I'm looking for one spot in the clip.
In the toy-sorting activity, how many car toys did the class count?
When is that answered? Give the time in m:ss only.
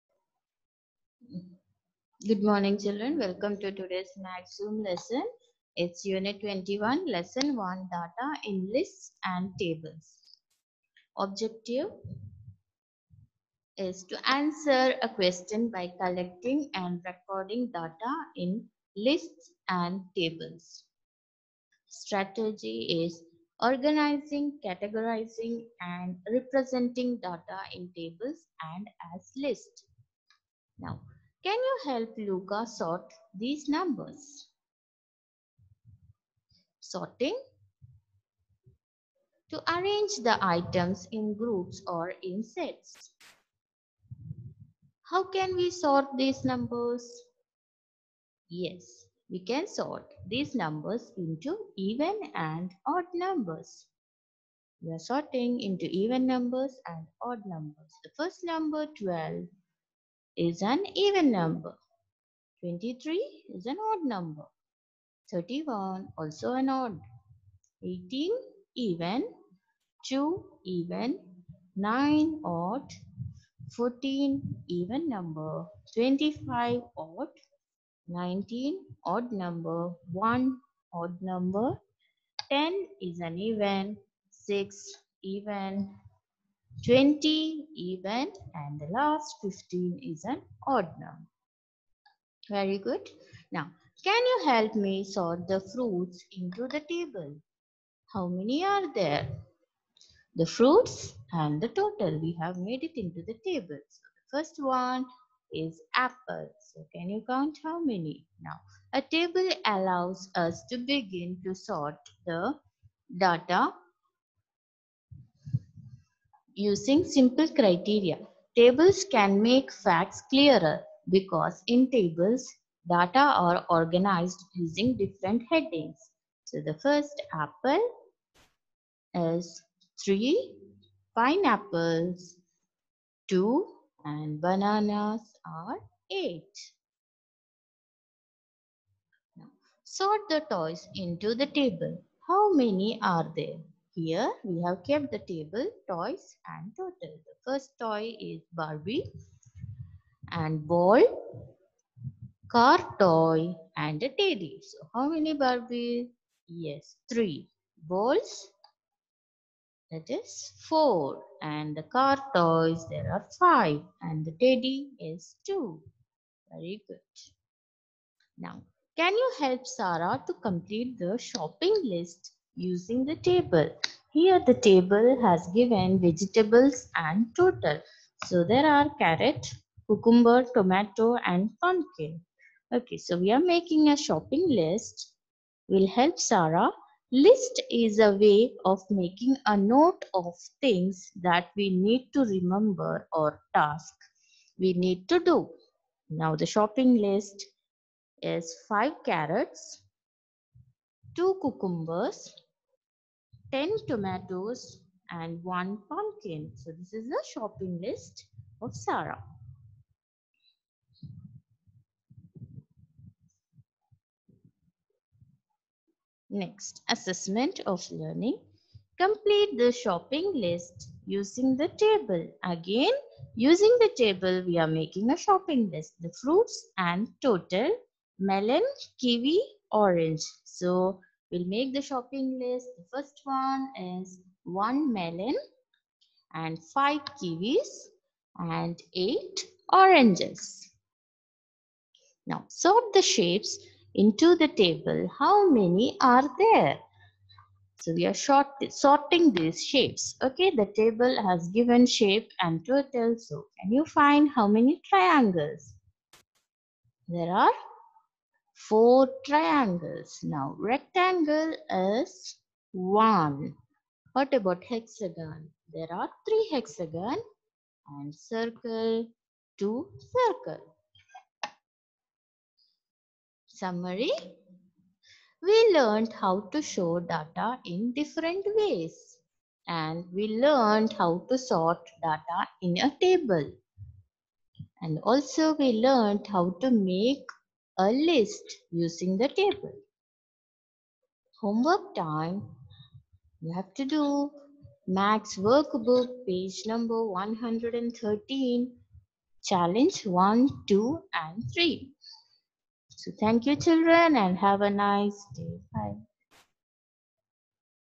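2:42.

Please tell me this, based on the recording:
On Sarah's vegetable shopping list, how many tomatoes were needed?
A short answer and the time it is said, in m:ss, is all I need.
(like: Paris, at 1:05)
10, at 3:23.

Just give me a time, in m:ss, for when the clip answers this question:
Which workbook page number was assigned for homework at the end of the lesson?
4:56.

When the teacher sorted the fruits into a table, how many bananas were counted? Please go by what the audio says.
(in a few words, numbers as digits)
8.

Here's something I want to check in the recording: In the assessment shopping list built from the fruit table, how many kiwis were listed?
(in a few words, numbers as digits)
5.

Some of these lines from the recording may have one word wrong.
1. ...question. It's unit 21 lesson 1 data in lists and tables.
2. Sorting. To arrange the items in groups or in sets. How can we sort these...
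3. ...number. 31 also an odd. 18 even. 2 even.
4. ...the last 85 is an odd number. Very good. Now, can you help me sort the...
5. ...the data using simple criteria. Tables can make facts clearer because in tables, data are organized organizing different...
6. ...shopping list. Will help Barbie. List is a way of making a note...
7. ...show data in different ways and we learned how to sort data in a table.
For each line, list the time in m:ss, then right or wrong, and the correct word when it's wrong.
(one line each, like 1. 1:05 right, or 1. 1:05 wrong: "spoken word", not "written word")
1. 0:04 wrong: "lesson", not "question"
2. 0:36 right
3. 1:04 right
4. 1:28 wrong: "15", not "85"
5. 1:52 wrong: "using", not "organizing"
6. 3:03 wrong: "Sarah", not "Barbie"
7. 4:36 right.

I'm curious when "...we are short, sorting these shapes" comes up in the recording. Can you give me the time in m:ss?
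4:07.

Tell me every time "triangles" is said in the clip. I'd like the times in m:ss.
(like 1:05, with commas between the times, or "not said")
4:14, 4:19.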